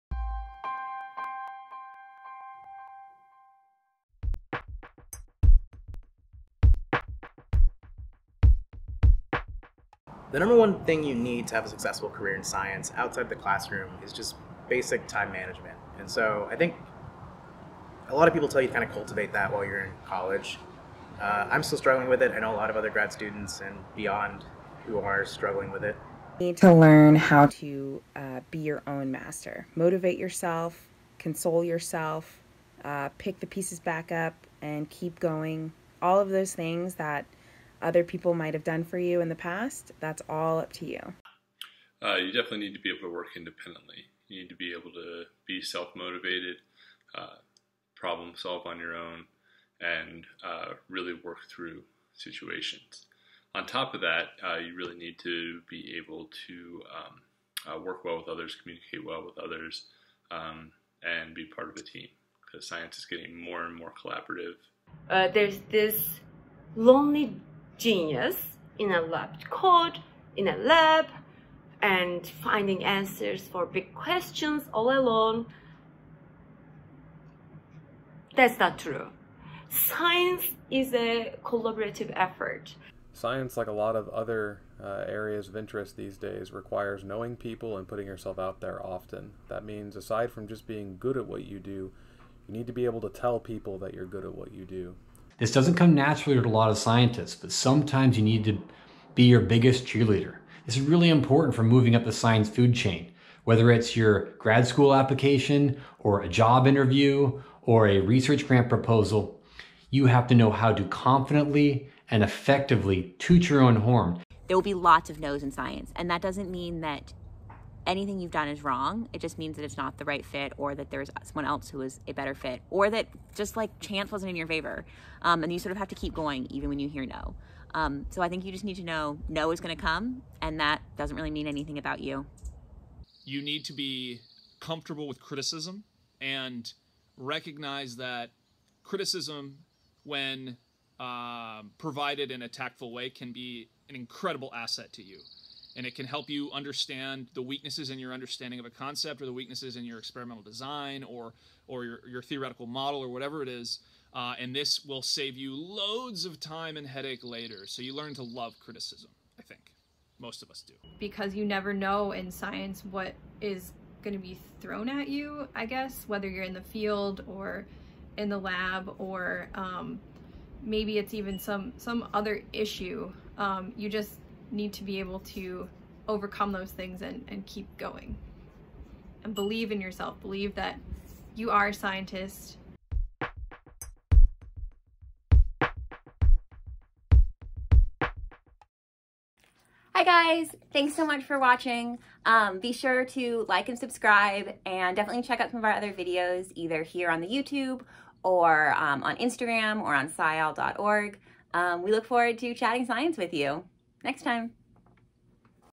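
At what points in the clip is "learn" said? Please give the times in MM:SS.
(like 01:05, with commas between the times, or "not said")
00:26, 02:37.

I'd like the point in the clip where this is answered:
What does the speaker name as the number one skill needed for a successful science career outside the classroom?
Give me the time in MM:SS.
00:14.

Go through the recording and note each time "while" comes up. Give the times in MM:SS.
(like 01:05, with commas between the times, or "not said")
00:19.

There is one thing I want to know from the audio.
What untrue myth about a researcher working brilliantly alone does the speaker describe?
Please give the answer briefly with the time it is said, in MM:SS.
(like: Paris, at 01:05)
lonely genius, at 01:06.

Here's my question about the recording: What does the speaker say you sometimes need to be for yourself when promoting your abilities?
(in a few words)
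cheerleader.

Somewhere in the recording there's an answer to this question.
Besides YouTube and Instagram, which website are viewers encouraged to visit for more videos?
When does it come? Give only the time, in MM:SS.
03:20.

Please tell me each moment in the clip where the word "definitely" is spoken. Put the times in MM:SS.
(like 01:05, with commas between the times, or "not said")
00:42, 03:14.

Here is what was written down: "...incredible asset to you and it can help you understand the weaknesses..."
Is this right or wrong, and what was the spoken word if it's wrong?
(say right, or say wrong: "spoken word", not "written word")
right.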